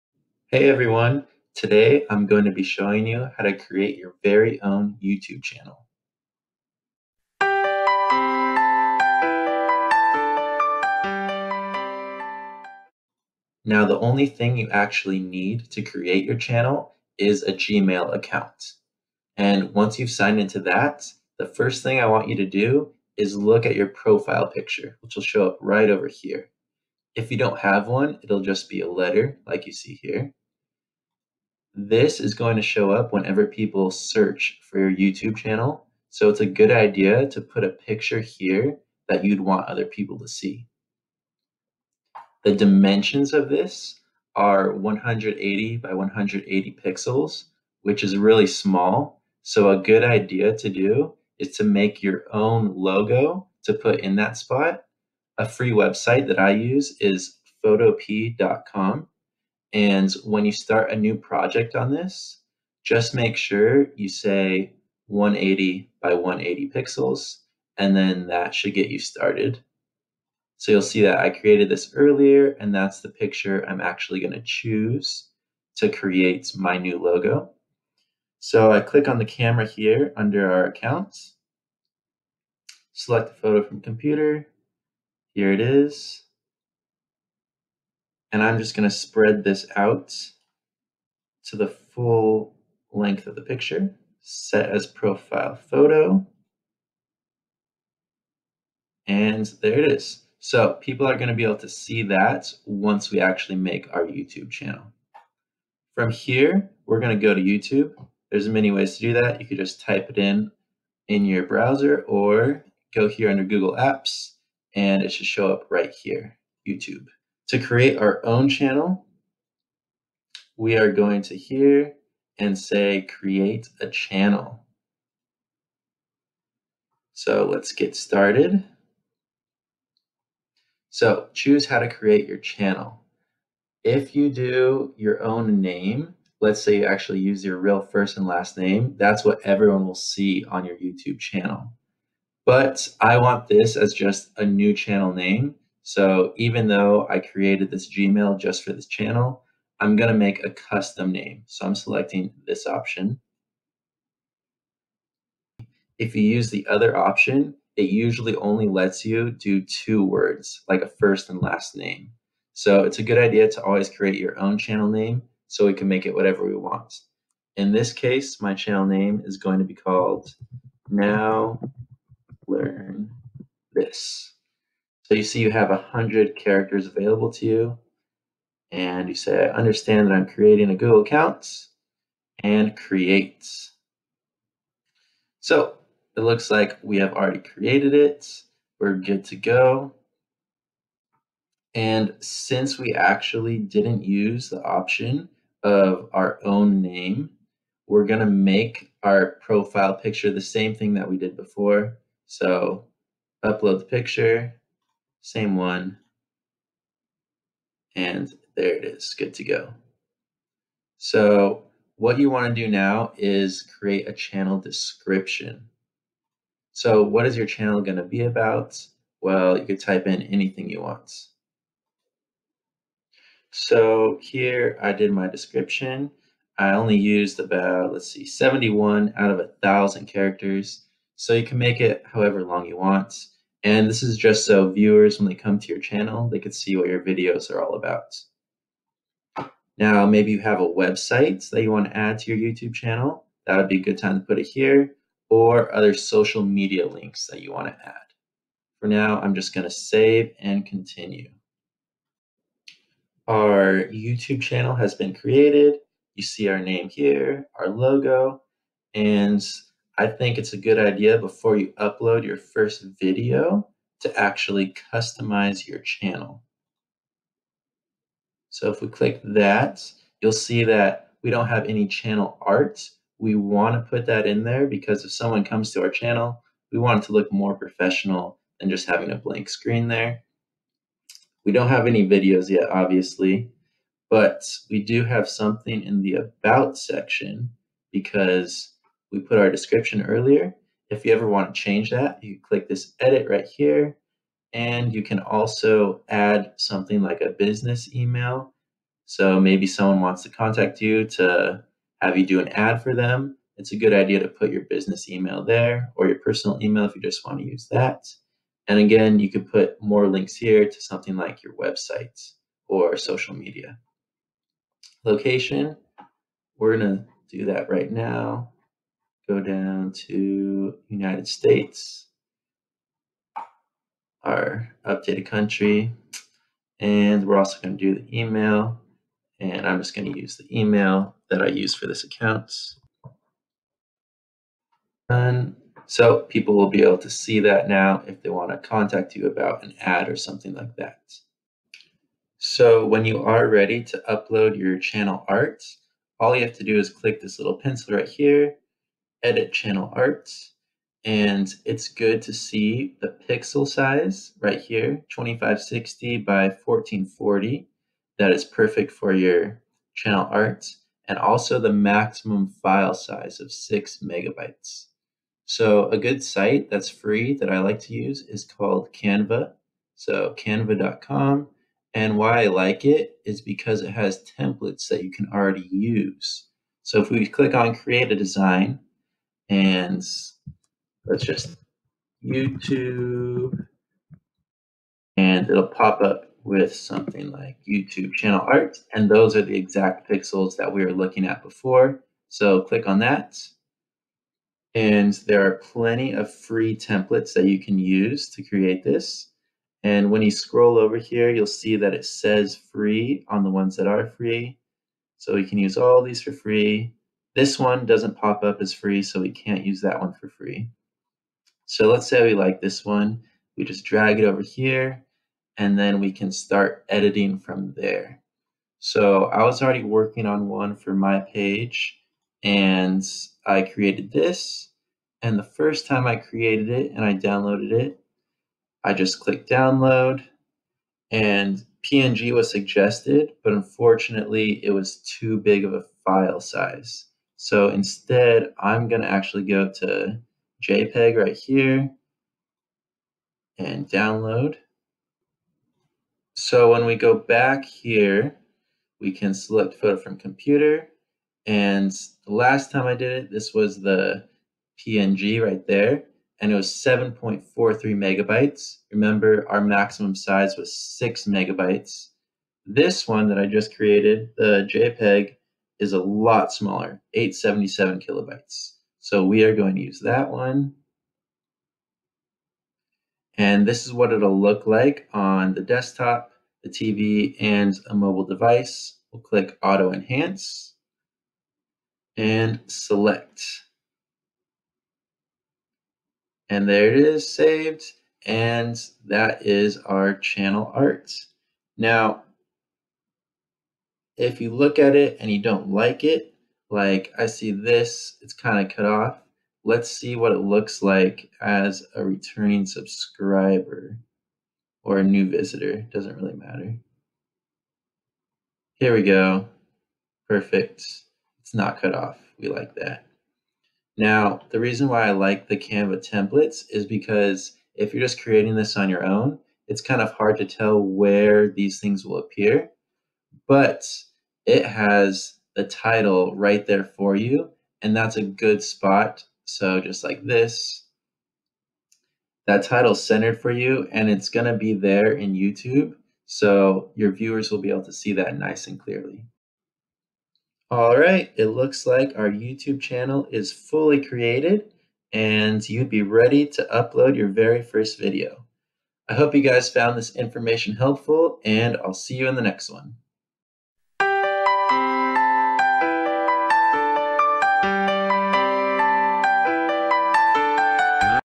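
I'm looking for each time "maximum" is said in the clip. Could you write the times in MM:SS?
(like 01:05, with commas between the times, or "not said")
06:01, 07:39.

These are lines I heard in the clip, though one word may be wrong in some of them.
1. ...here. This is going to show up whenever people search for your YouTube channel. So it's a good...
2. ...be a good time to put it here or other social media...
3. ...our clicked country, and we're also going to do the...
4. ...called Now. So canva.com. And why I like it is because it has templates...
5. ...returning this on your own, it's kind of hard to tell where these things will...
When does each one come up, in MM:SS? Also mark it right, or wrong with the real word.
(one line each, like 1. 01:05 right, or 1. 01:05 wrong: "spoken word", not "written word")
1. 00:30 right
2. 04:03 right
3. 05:24 wrong: "updated", not "clicked"
4. 06:08 wrong: "Canva", not "Now"
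5. 08:38 wrong: "creating", not "returning".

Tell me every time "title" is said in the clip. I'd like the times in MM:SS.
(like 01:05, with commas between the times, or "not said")
08:45, 08:52.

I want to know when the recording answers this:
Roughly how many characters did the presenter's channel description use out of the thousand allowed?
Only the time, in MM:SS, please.
03:48.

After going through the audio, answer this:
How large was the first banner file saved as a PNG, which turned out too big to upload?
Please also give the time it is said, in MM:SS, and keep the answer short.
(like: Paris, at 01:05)
7.43 megabytes, at 07:36.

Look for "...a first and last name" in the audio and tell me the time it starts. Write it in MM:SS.
02:40.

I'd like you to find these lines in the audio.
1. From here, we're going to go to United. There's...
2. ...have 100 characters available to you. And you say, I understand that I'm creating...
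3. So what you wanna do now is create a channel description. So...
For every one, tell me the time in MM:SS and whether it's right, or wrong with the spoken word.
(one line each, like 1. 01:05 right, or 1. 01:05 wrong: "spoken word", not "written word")
1. 01:45 wrong: "YouTube", not "United"
2. 02:55 right
3. 03:30 right.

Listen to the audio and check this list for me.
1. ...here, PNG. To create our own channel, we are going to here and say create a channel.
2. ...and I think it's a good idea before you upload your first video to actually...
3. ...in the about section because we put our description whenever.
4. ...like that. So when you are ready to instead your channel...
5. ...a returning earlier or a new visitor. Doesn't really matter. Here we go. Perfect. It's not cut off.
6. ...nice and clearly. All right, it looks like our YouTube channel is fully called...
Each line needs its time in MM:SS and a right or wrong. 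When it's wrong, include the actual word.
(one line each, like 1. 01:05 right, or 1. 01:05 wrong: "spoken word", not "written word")
1. 01:55 wrong: "YouTube", not "PNG"
2. 04:18 right
3. 04:45 wrong: "earlier", not "whenever"
4. 05:40 wrong: "upload", not "instead"
5. 08:21 wrong: "subscriber", not "earlier"
6. 08:58 wrong: "created", not "called".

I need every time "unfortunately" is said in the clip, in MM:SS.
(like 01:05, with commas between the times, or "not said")
07:13.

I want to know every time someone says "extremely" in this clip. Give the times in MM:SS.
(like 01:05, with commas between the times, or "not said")
not said.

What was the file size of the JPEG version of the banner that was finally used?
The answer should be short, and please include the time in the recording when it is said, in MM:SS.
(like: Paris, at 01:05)
877 kilobytes, at 07:47.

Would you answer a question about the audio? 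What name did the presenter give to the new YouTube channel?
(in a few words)
Now Learn This.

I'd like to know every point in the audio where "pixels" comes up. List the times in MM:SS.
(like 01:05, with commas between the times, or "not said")
00:46, 01:06, 05:53, 06:30.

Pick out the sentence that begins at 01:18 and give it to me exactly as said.
So I click on the camera here under our account, select the photo from computer.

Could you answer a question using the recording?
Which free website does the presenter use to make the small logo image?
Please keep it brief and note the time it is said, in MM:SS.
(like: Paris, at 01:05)
photop.com, at 00:57.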